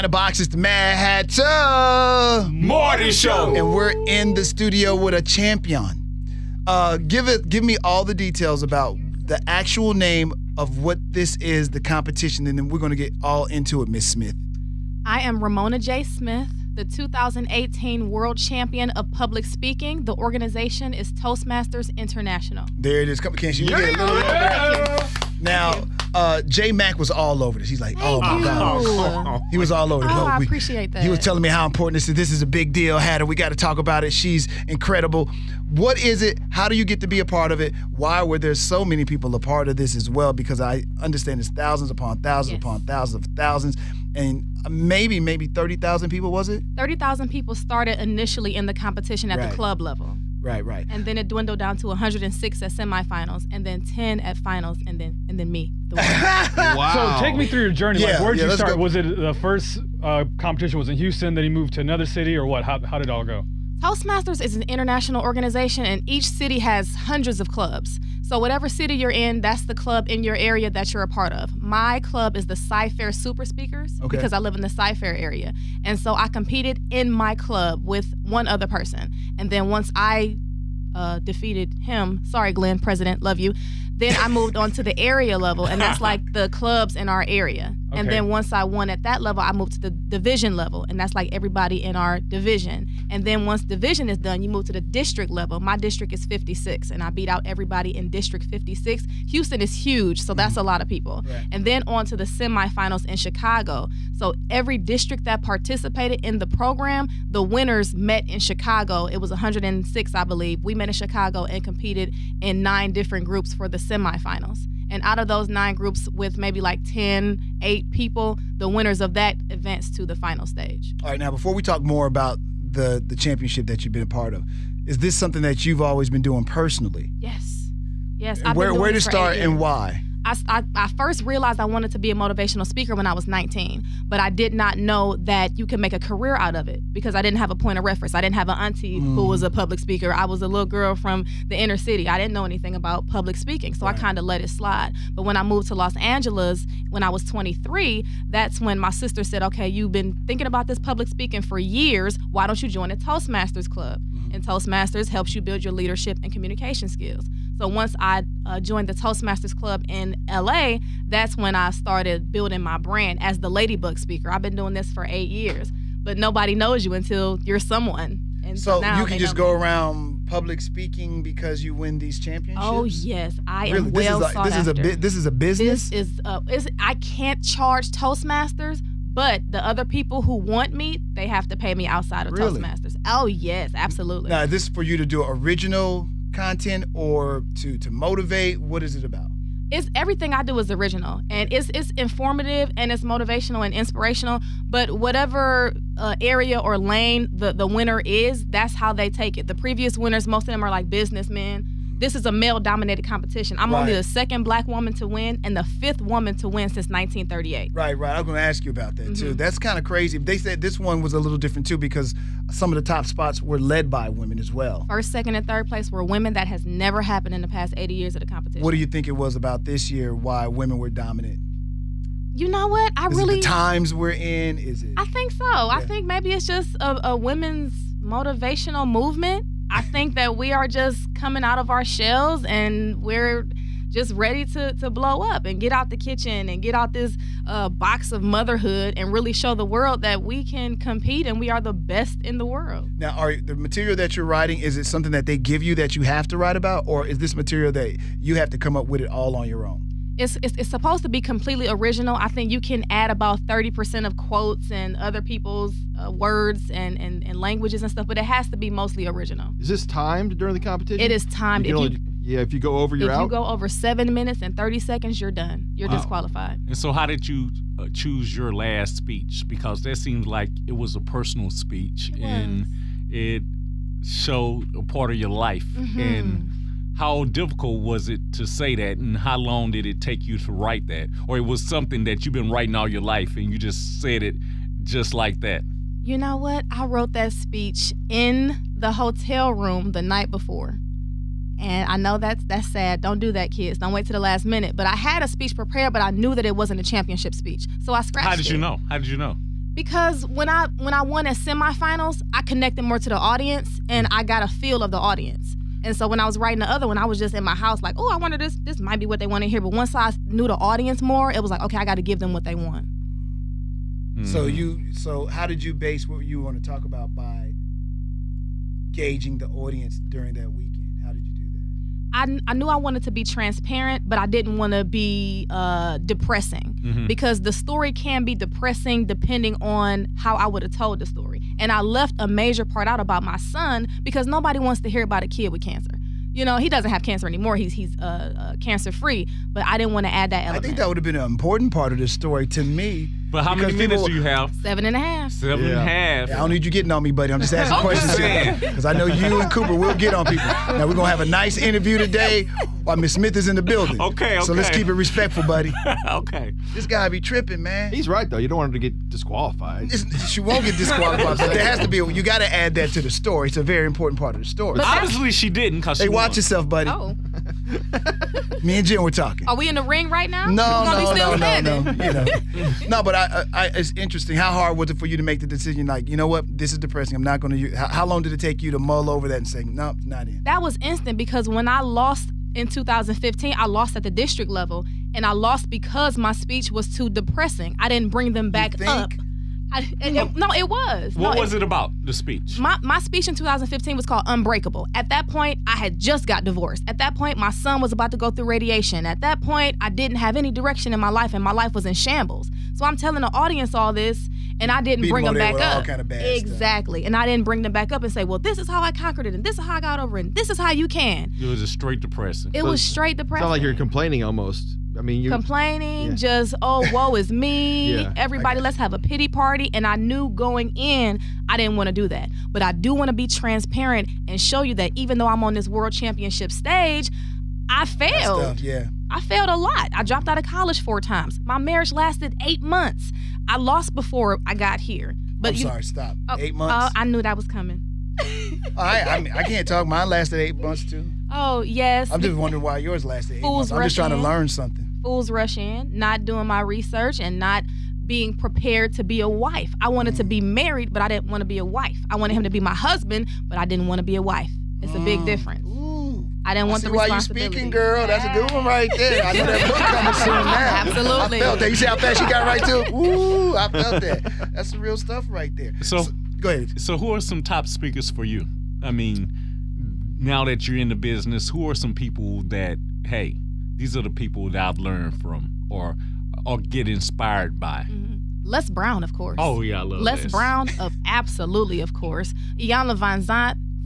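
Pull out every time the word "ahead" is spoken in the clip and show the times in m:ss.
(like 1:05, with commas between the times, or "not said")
7:46.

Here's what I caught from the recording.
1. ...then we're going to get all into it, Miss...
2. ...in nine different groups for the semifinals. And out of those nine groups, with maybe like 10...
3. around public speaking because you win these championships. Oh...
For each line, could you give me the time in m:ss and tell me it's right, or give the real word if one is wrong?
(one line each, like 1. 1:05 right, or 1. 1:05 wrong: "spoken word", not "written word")
1. 0:12 right
2. 1:52 right
3. 2:49 right.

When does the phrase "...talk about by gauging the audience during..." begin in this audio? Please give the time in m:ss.
5:16.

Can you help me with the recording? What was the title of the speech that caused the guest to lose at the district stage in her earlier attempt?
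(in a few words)
Unbreakable.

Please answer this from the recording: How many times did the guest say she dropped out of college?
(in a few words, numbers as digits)
4.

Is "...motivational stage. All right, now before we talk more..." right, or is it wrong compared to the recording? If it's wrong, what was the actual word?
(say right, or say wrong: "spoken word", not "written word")
wrong: "final", not "motivational".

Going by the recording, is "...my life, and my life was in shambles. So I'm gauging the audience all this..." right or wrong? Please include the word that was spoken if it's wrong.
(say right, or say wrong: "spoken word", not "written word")
wrong: "telling", not "gauging".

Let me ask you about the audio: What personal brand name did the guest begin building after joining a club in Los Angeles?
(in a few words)
the Ladybug speaker.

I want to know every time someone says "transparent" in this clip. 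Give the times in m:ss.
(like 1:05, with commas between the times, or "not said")
5:23, 7:03.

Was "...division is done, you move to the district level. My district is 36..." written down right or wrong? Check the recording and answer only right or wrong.
wrong.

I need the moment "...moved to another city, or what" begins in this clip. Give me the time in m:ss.
1:01.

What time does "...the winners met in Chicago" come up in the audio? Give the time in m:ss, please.
1:47.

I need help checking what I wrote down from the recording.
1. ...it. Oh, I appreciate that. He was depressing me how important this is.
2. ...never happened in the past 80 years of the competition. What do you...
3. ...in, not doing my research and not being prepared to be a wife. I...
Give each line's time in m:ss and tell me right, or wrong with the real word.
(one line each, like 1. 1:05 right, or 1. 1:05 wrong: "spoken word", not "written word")
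1. 0:30 wrong: "telling", not "depressing"
2. 3:36 right
3. 7:25 right.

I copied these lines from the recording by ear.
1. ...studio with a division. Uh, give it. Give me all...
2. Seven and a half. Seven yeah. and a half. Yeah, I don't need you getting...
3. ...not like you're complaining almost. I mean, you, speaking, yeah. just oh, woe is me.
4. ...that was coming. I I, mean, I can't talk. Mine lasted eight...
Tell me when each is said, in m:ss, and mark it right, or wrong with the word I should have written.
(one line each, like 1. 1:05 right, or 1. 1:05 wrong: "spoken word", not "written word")
1. 0:04 wrong: "champion", not "division"
2. 5:44 right
3. 6:53 wrong: "complaining", not "speaking"
4. 7:17 right.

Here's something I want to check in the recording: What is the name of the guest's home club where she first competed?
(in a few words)
Cyfair Super Speakers.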